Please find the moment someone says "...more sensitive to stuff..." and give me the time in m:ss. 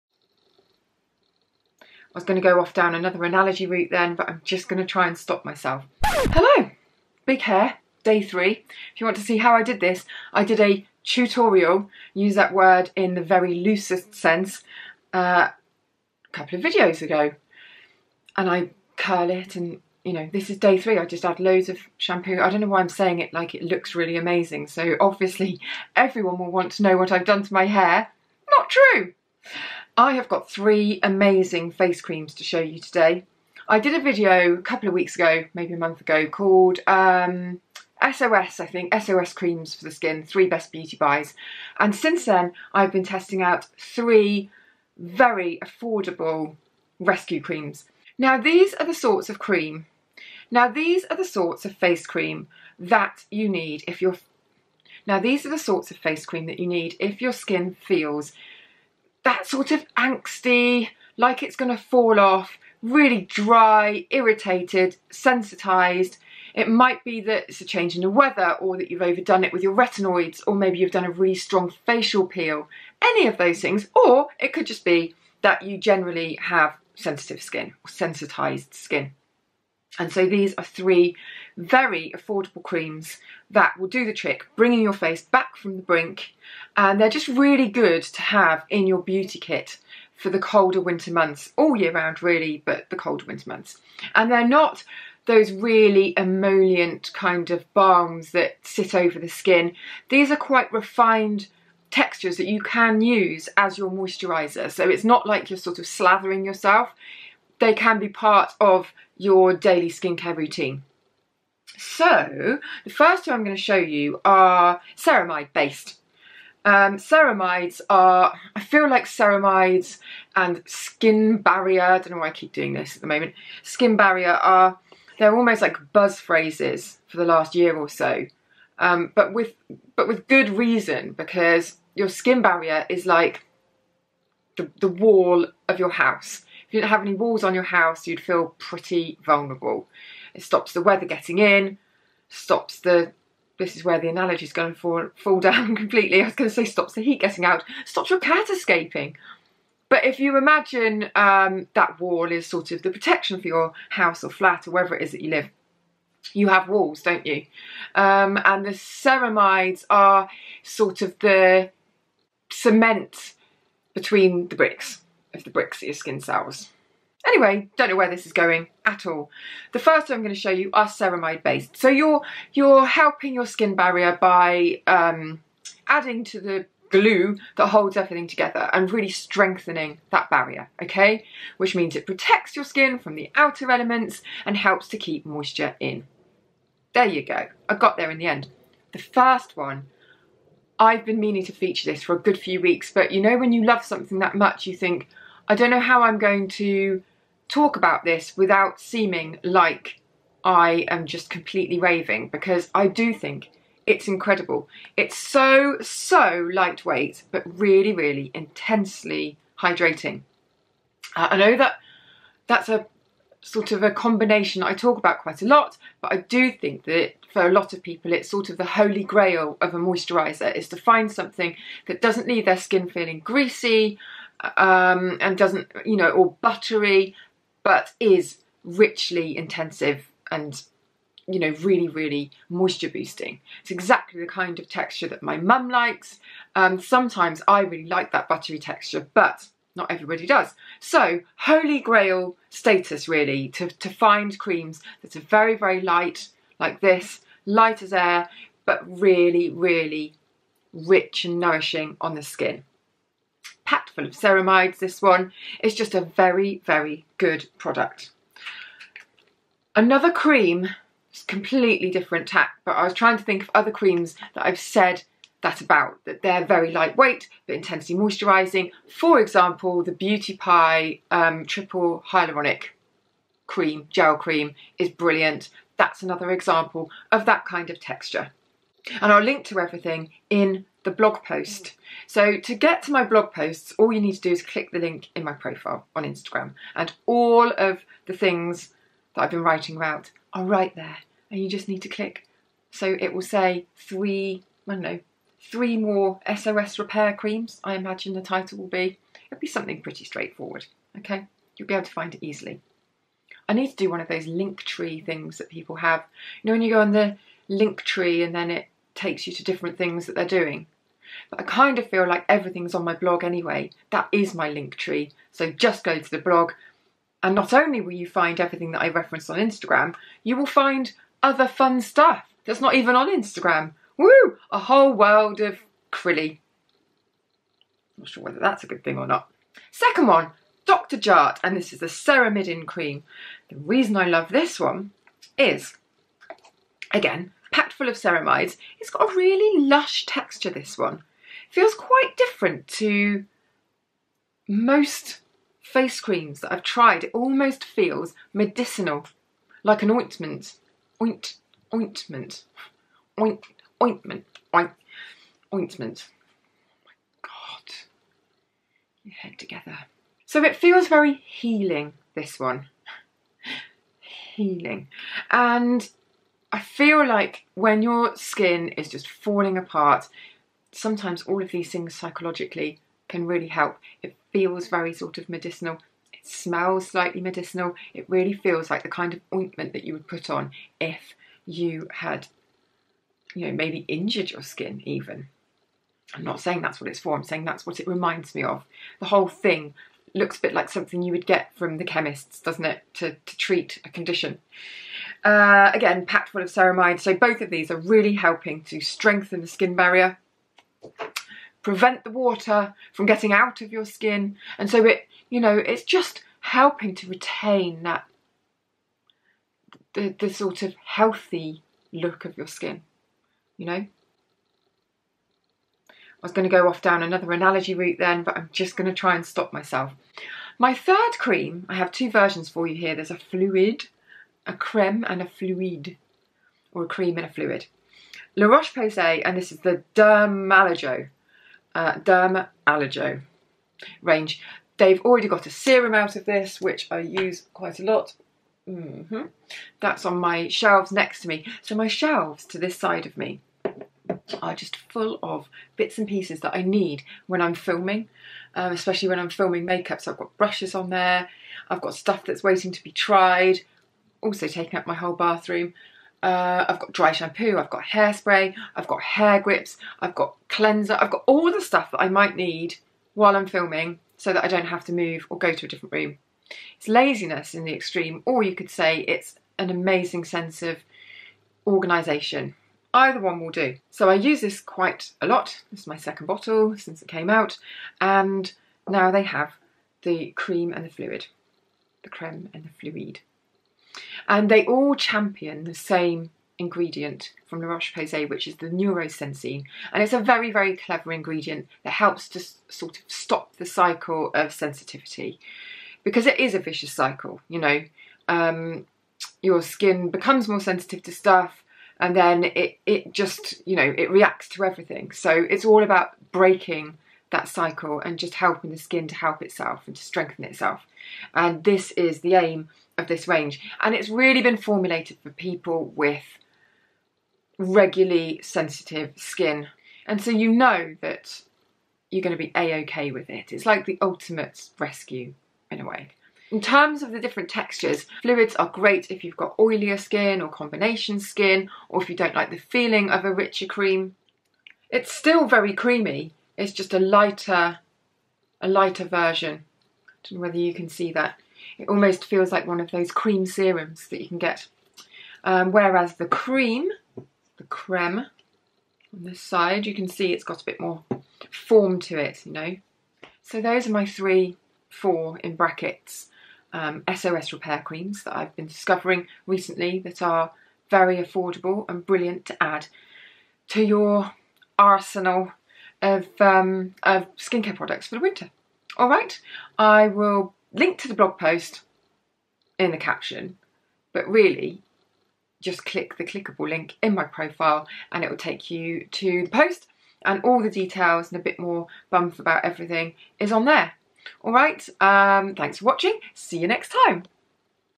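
8:20.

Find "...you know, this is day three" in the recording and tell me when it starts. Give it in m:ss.
0:20.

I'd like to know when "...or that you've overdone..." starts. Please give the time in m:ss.
1:08.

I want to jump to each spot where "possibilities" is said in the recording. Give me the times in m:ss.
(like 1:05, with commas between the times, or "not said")
not said.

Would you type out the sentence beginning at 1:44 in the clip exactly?
So it's not like you're sort of slathering yourself.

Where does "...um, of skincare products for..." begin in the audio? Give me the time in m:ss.
9:26.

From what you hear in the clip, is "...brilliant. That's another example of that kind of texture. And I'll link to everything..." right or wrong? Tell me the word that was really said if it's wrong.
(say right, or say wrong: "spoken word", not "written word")
right.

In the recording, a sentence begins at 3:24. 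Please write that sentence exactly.
It's so, so lightweight, but really, really intensely hydrating.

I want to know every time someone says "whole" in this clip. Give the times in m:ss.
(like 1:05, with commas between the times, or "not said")
5:24, 6:29, 7:34.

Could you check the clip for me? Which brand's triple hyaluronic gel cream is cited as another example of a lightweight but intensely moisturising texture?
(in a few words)
Beauty Pie.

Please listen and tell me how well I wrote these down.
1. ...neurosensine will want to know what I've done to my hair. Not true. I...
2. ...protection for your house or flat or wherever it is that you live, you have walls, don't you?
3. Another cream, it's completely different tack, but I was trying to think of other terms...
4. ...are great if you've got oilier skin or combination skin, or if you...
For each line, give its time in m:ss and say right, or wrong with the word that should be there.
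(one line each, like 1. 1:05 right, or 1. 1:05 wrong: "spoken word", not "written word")
1. 0:25 wrong: "everyone", not "neurosensine"
2. 2:32 right
3. 4:19 wrong: "creams", not "terms"
4. 8:48 right.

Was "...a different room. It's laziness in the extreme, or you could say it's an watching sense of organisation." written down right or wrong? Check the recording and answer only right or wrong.
wrong.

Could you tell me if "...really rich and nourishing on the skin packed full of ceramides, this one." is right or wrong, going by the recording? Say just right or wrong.
right.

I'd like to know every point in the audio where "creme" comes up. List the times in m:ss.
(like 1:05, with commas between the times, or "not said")
7:04, 8:02, 9:07.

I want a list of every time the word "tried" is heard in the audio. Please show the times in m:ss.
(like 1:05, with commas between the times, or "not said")
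5:46, 7:32.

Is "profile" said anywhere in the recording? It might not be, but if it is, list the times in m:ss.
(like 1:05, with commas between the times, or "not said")
4:45, 9:37.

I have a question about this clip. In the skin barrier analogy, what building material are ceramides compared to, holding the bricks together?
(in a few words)
Cement.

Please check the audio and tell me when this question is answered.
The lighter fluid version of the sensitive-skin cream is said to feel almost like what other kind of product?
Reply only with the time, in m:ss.
9:03.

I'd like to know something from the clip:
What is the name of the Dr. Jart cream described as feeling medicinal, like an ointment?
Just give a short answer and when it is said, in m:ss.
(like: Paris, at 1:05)
Ceramidin, at 5:31.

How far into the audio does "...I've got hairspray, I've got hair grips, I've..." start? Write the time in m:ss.
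7:37.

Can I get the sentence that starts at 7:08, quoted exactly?
La Roche-Posay, and this is the Dermallergo, uh, range.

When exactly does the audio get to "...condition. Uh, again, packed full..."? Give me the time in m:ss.
6:33.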